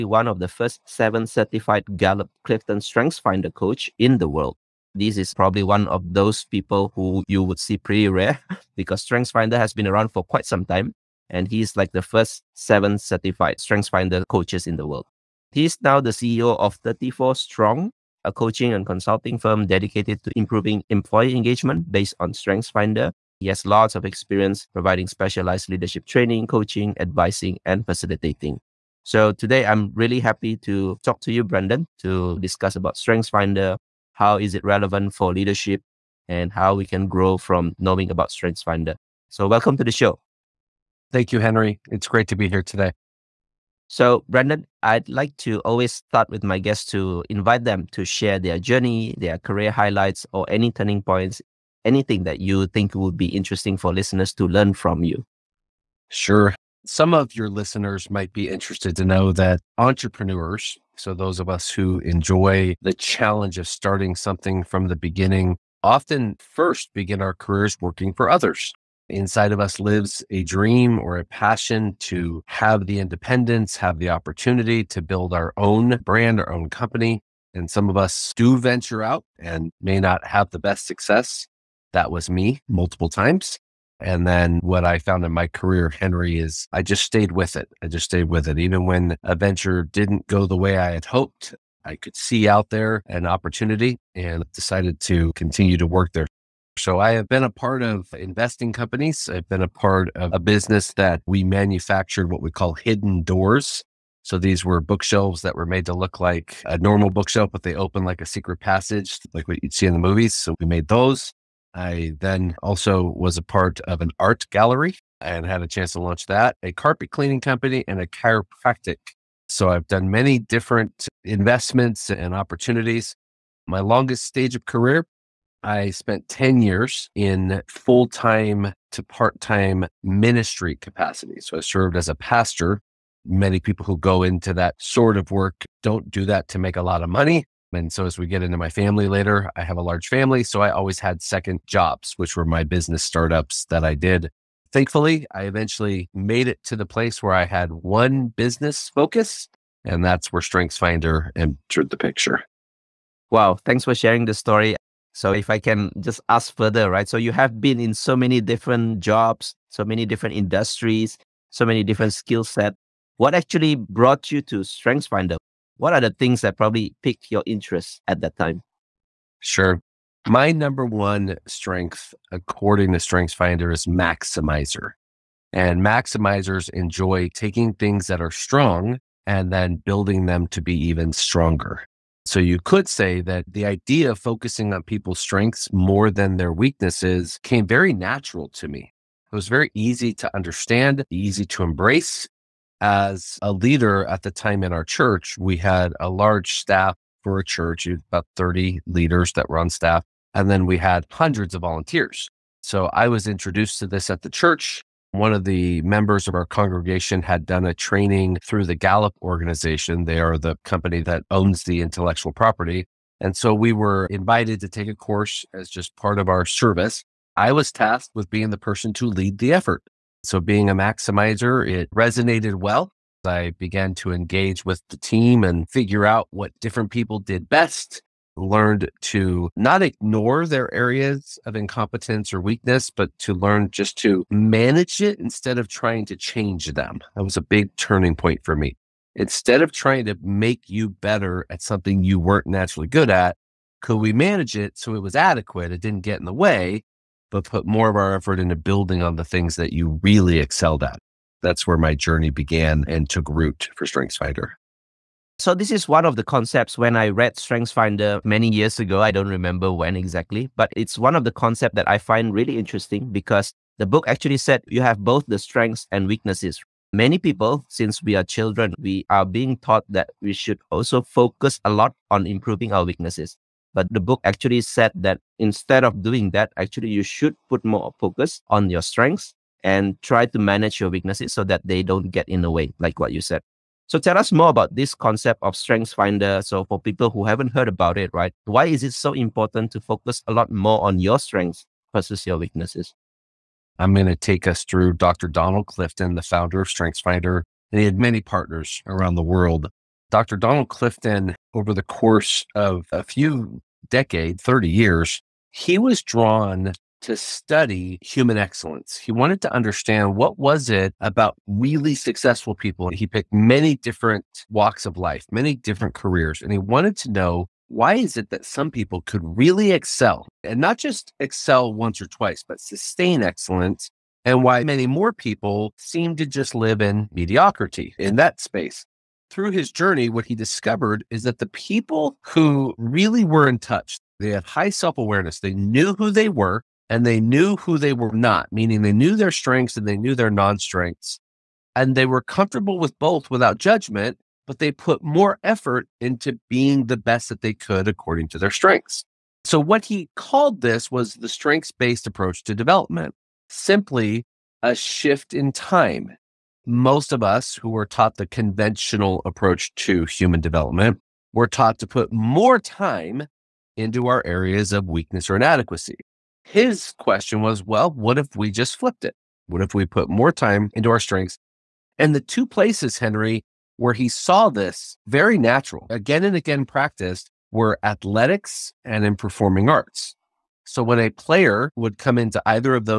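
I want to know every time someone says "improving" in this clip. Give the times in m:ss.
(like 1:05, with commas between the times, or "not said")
0:20, 4:32.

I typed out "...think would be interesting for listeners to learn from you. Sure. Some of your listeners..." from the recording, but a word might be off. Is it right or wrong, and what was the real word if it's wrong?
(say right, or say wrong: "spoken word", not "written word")
right.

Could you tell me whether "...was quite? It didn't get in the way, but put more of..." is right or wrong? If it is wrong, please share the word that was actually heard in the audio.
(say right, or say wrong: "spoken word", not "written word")
wrong: "adequate", not "quite".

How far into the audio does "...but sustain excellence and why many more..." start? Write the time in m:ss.
5:22.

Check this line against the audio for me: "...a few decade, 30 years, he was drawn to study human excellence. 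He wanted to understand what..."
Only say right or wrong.
right.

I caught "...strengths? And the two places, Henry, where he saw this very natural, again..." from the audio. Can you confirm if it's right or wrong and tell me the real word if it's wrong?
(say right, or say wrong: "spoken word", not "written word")
right.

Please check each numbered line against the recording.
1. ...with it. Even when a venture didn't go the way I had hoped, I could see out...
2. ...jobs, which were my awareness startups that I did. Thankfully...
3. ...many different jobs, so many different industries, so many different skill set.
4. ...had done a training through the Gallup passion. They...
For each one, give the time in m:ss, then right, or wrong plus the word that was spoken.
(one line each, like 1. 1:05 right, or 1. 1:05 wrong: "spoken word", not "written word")
1. 1:28 right
2. 2:21 wrong: "business", not "awareness"
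3. 2:38 right
4. 3:27 wrong: "organization", not "passion".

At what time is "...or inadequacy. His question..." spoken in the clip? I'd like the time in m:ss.
6:05.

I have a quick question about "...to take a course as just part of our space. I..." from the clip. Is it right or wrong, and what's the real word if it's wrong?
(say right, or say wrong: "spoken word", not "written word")
wrong: "service", not "space".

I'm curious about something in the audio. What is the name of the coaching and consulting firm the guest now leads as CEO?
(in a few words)
34 Strong.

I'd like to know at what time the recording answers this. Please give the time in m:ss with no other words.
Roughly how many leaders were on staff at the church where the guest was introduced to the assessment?
3:17.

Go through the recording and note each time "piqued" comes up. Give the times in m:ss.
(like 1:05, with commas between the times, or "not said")
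2:47.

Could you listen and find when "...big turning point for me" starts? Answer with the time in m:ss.
3:57.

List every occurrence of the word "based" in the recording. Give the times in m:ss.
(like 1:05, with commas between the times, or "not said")
0:21, 5:51.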